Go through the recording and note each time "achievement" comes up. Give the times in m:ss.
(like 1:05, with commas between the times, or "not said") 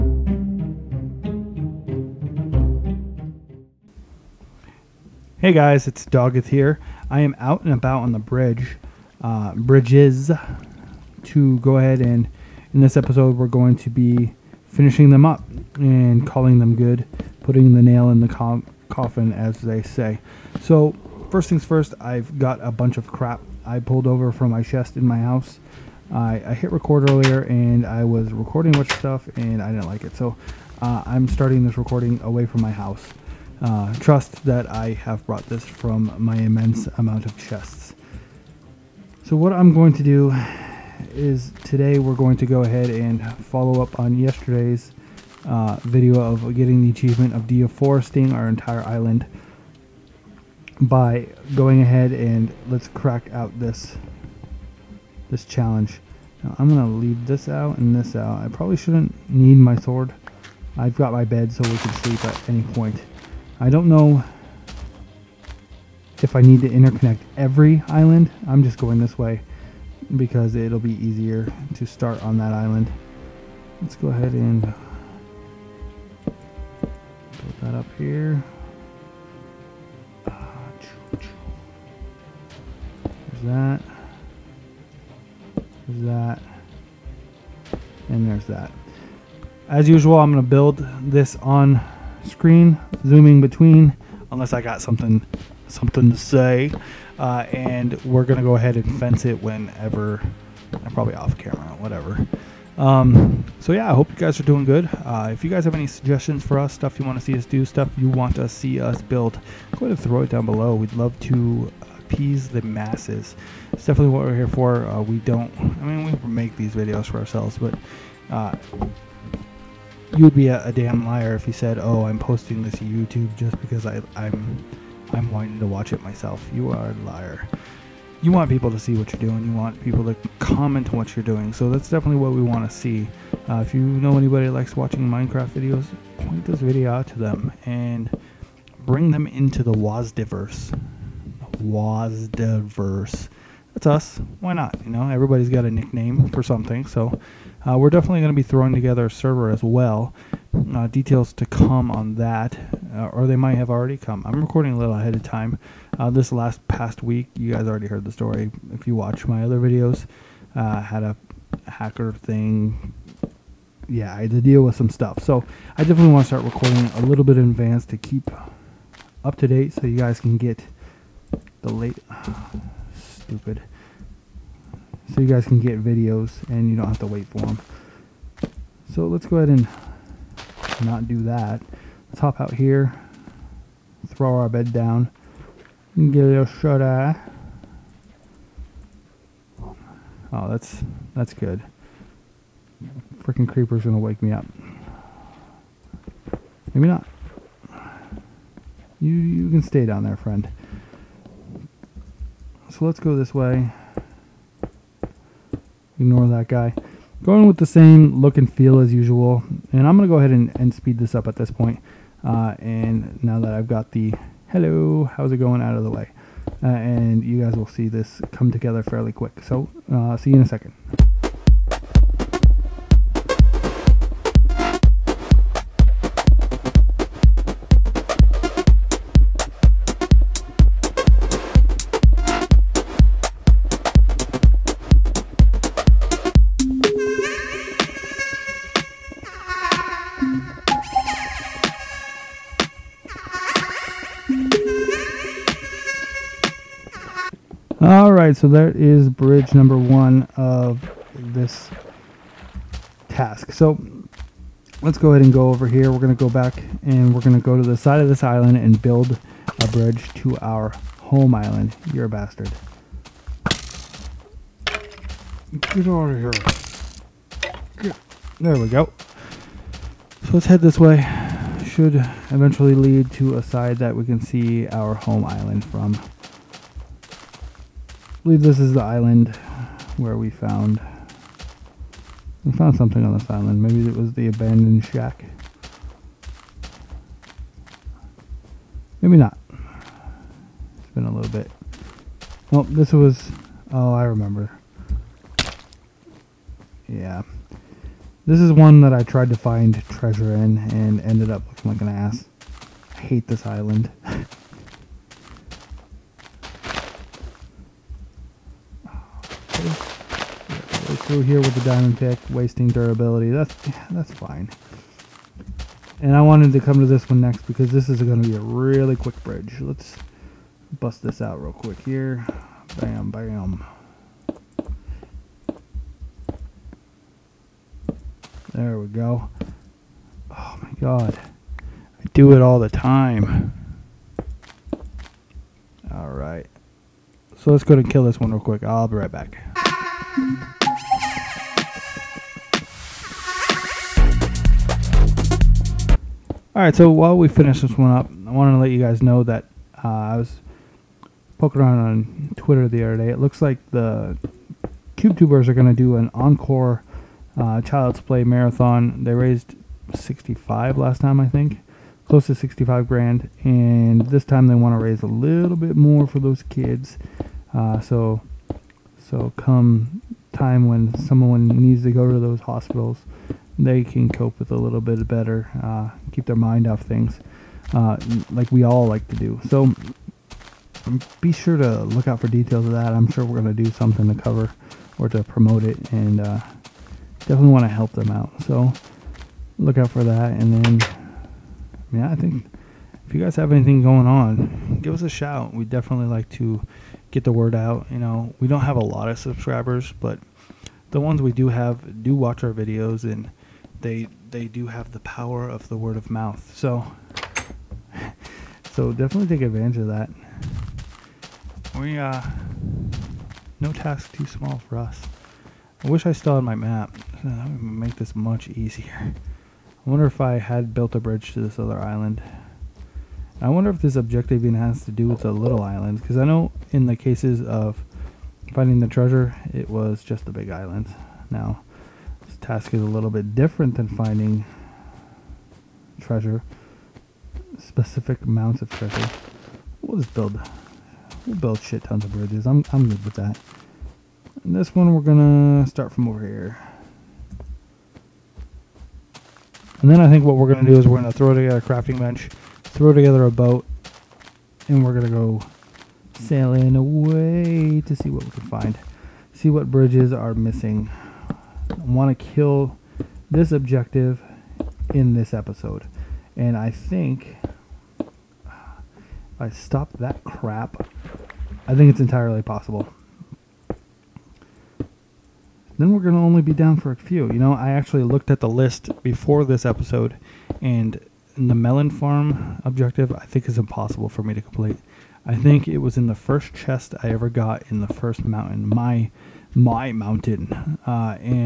0:46.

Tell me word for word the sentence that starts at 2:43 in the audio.
Yeah, I had to deal with some stuff.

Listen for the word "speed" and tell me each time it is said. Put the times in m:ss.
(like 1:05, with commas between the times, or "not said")
3:30.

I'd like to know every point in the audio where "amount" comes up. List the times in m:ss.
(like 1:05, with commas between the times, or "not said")
0:36, 7:18.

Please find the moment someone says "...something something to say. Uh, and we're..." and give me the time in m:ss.
1:34.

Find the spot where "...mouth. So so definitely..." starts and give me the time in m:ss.
6:46.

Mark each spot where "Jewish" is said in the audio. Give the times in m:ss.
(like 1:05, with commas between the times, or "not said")
not said.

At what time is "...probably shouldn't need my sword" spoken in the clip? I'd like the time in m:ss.
0:58.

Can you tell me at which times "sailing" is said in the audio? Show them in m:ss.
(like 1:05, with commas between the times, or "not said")
7:36.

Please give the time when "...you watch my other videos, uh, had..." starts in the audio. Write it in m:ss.
2:38.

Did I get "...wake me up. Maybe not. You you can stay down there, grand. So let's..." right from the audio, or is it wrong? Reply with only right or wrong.
wrong.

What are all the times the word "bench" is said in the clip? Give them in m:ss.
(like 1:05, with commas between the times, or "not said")
7:31.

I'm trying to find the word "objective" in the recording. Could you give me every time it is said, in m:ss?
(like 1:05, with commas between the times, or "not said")
7:03, 7:43, 8:02.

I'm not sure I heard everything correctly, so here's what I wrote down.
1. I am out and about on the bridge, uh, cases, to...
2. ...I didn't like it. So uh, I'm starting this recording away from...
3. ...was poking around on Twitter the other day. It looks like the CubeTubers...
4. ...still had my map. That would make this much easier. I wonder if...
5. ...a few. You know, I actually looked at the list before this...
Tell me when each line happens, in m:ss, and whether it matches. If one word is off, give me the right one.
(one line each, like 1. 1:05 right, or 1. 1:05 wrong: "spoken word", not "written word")
1. 0:07 wrong: "bridges", not "cases"
2. 0:29 right
3. 5:50 right
4. 6:56 right
5. 7:56 right.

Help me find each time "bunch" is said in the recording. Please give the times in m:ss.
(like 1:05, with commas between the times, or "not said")
0:22, 0:28.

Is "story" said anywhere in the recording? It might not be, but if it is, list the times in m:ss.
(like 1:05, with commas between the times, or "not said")
2:38.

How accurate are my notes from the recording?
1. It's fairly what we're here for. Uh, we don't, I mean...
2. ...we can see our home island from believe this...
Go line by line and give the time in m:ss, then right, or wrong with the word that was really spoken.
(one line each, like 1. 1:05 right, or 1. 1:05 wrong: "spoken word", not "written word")
1. 1:53 wrong: "definitely", not "fairly"
2. 4:33 right.